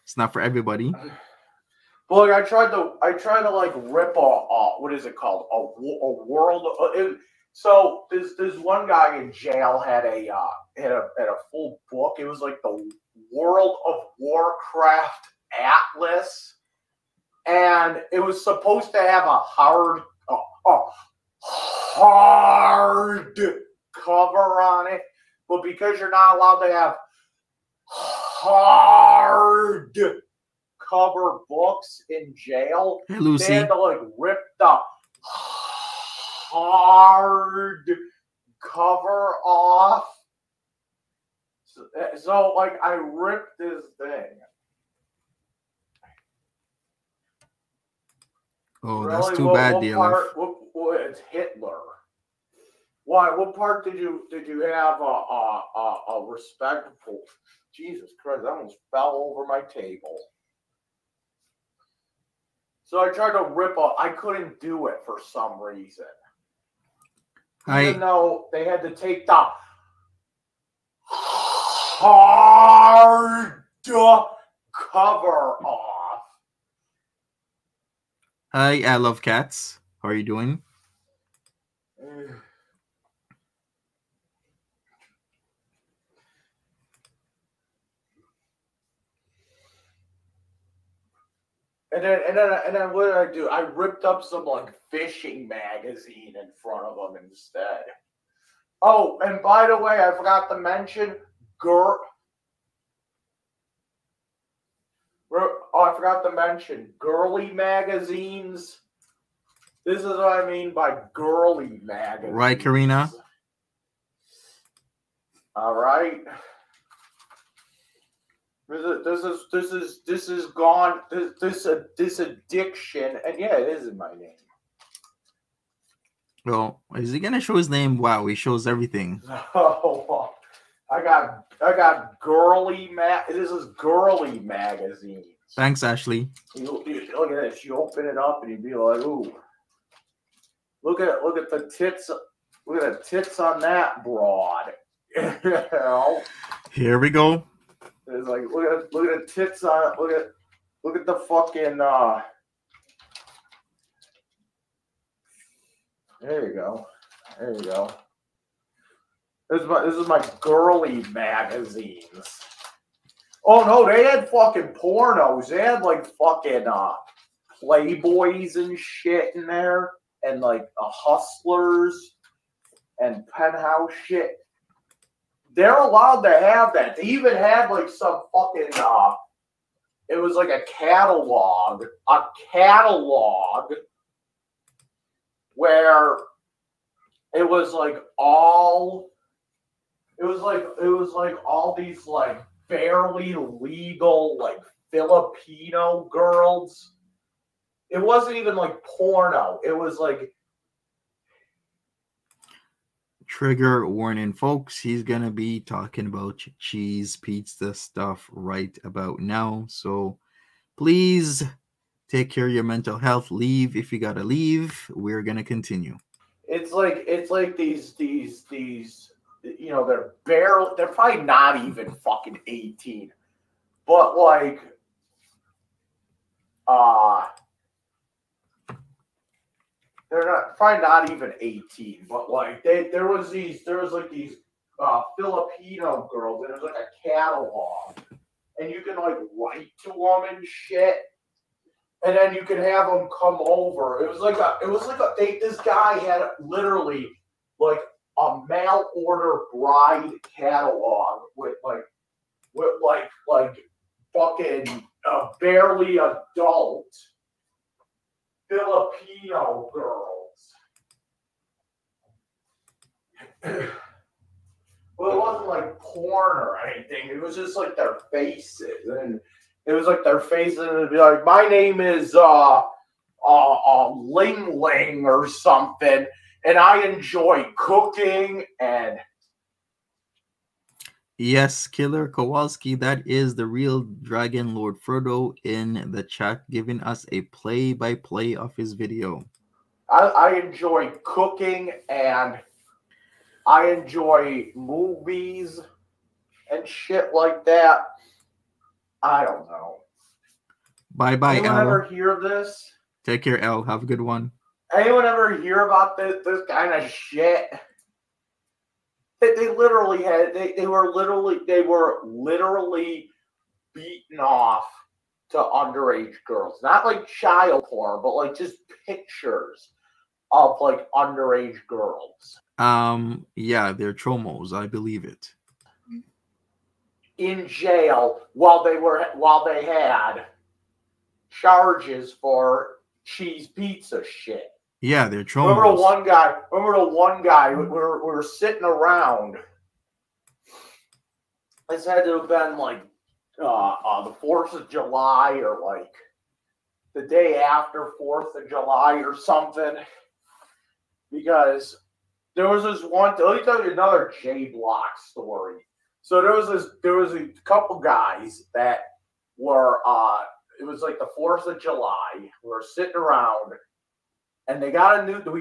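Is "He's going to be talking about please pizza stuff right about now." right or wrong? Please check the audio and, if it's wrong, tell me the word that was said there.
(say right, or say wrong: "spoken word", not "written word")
wrong: "cheese", not "please".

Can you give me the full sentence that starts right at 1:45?
Oh, I forgot to mention girly magazines.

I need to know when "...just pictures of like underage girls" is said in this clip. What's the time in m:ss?
5:18.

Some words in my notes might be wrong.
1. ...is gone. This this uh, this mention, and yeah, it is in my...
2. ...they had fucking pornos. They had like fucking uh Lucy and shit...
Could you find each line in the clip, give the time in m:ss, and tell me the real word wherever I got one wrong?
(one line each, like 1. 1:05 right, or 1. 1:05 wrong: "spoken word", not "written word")
1. 2:00 wrong: "addiction", not "mention"
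2. 2:43 wrong: "Playboys", not "Lucy".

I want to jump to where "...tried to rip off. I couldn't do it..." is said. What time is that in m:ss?
1:03.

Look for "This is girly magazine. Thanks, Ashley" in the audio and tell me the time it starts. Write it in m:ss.
2:13.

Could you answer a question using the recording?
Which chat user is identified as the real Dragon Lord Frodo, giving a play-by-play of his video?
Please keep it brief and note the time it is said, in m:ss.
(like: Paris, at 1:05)
Killer Kowalski, at 4:41.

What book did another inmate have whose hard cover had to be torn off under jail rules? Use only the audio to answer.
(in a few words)
World of Warcraft Atlas.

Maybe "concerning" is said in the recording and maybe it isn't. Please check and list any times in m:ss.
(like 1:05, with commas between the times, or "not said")
not said.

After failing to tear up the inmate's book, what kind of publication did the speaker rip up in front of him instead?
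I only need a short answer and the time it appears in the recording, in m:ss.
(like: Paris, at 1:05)
Fishing magazine, at 1:34.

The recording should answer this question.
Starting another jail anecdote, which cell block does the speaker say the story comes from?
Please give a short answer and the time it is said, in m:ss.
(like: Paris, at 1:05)
J Block, at 5:54.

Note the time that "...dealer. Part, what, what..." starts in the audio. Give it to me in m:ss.
0:49.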